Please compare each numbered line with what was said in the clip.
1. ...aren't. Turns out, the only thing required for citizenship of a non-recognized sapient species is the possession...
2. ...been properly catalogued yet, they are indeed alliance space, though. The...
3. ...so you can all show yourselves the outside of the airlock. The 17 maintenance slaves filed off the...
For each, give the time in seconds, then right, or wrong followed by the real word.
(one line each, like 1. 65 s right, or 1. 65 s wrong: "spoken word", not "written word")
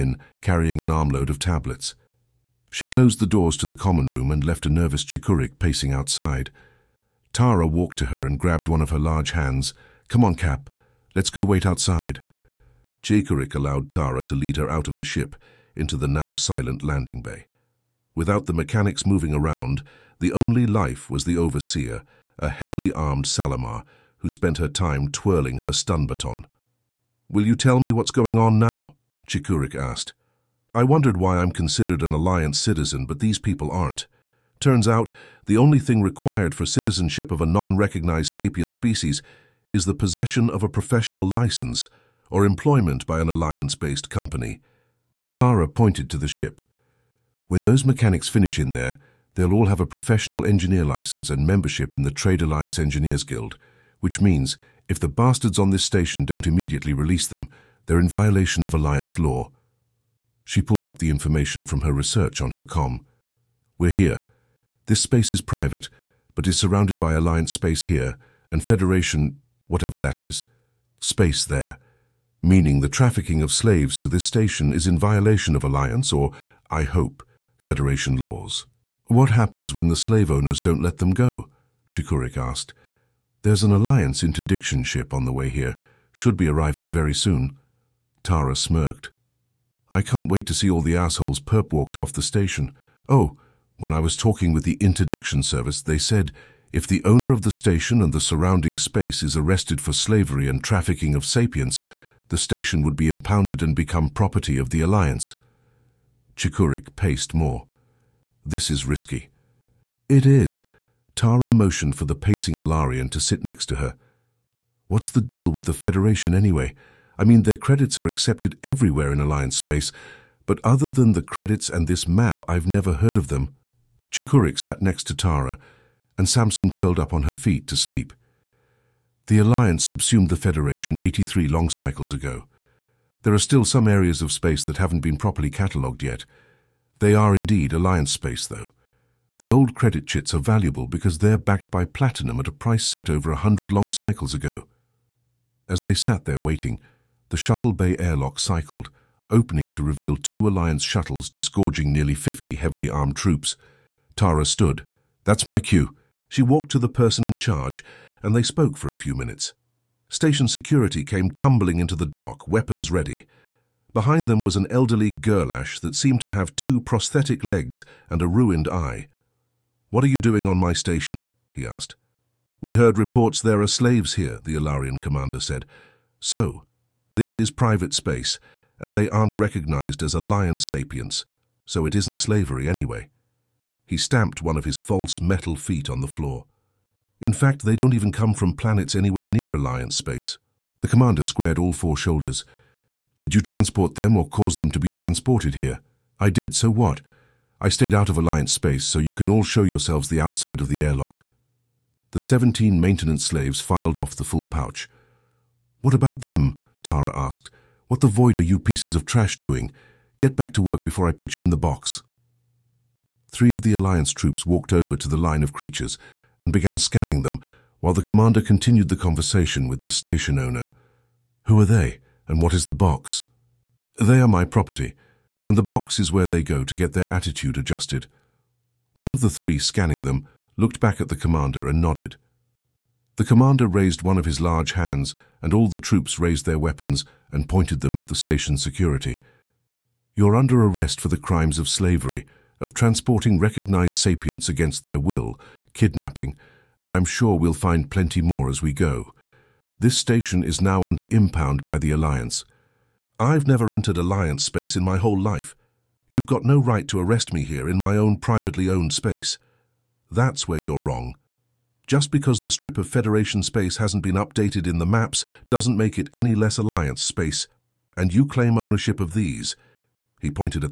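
1. 33 s right
2. 135 s right
3. 198 s right.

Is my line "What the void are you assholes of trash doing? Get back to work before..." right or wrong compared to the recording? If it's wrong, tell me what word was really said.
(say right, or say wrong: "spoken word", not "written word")
wrong: "pieces", not "assholes".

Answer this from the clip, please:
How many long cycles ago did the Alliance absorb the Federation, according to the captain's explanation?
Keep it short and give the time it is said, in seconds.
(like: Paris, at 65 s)
83, at 130 s.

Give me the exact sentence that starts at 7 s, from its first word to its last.
Tara walked to her and grabbed one of her large hands.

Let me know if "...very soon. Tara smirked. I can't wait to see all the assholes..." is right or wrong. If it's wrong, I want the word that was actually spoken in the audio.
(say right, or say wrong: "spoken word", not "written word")
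right.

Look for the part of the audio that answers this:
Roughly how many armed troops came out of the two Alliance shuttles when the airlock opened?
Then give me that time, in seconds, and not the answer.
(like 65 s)
152 s.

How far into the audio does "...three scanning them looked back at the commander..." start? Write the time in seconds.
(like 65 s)
229 s.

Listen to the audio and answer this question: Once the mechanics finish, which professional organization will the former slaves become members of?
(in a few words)
Trade Alliance Engineers Guild.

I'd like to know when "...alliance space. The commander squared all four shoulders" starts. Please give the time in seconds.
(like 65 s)
189 s.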